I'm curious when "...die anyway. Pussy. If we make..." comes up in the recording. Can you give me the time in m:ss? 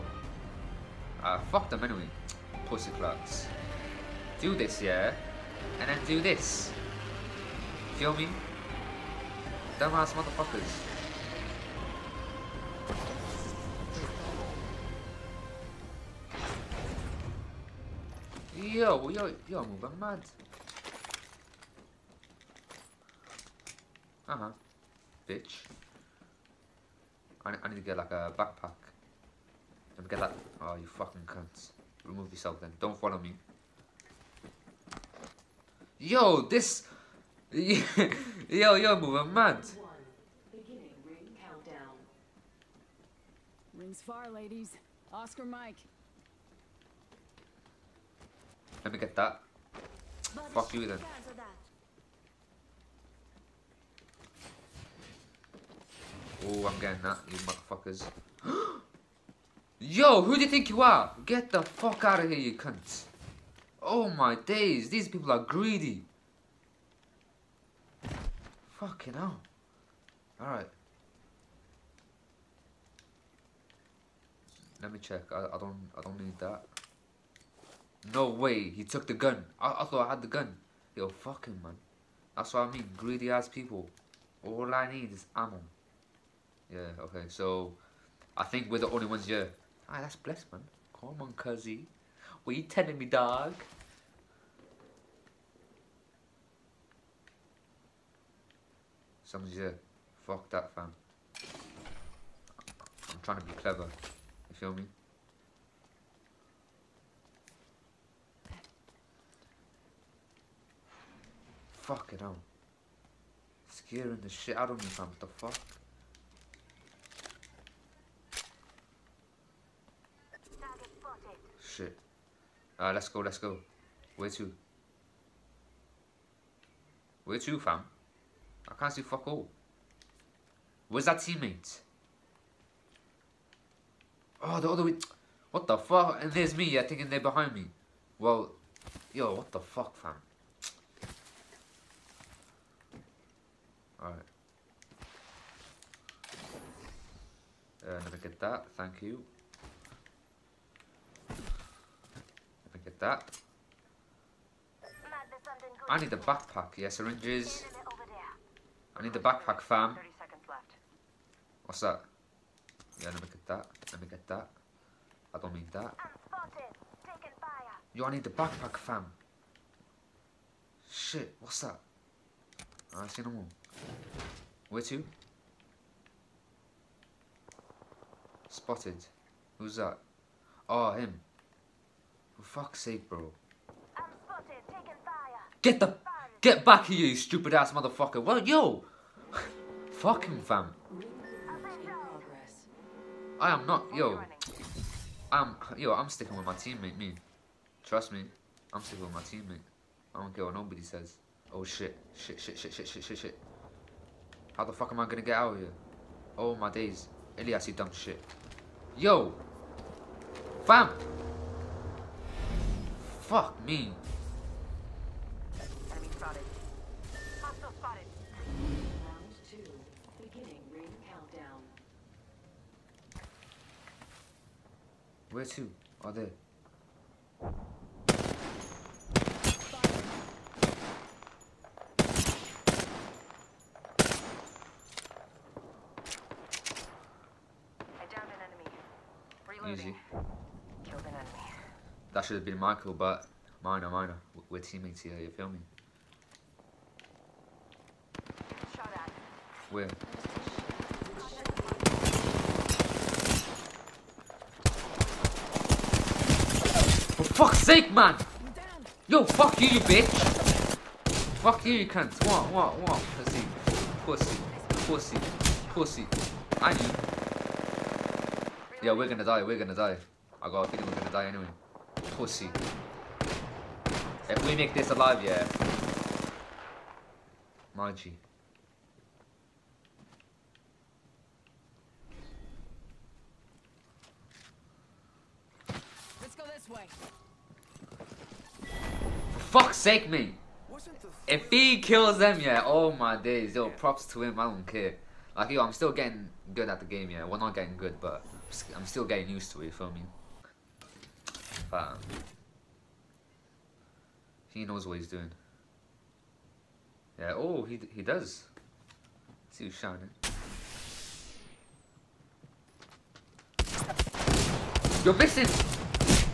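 4:31.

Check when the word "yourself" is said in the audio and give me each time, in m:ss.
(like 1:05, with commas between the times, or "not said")
0:32.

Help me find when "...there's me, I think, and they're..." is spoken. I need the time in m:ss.
2:16.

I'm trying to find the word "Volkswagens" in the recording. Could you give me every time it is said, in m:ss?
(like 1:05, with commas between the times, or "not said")
not said.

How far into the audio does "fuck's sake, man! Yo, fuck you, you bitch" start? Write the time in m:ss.
4:17.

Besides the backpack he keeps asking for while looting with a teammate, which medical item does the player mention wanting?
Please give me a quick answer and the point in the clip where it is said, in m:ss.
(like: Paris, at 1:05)
syringes, at 2:36.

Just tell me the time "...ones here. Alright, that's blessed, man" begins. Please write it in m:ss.
1:29.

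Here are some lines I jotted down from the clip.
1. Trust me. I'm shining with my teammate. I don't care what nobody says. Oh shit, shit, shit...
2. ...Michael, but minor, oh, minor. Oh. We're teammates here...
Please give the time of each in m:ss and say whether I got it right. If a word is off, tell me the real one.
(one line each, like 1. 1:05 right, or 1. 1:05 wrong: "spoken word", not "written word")
1. 3:17 wrong: "sticking", not "shining"
2. 4:02 right.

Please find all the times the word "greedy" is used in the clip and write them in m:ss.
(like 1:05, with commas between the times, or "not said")
1:05, 1:22.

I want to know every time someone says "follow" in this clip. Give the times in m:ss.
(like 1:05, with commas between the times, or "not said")
0:32.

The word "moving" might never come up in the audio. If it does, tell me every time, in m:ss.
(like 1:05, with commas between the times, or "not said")
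0:19, 0:38.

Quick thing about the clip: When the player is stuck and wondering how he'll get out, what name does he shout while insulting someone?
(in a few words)
Elyas.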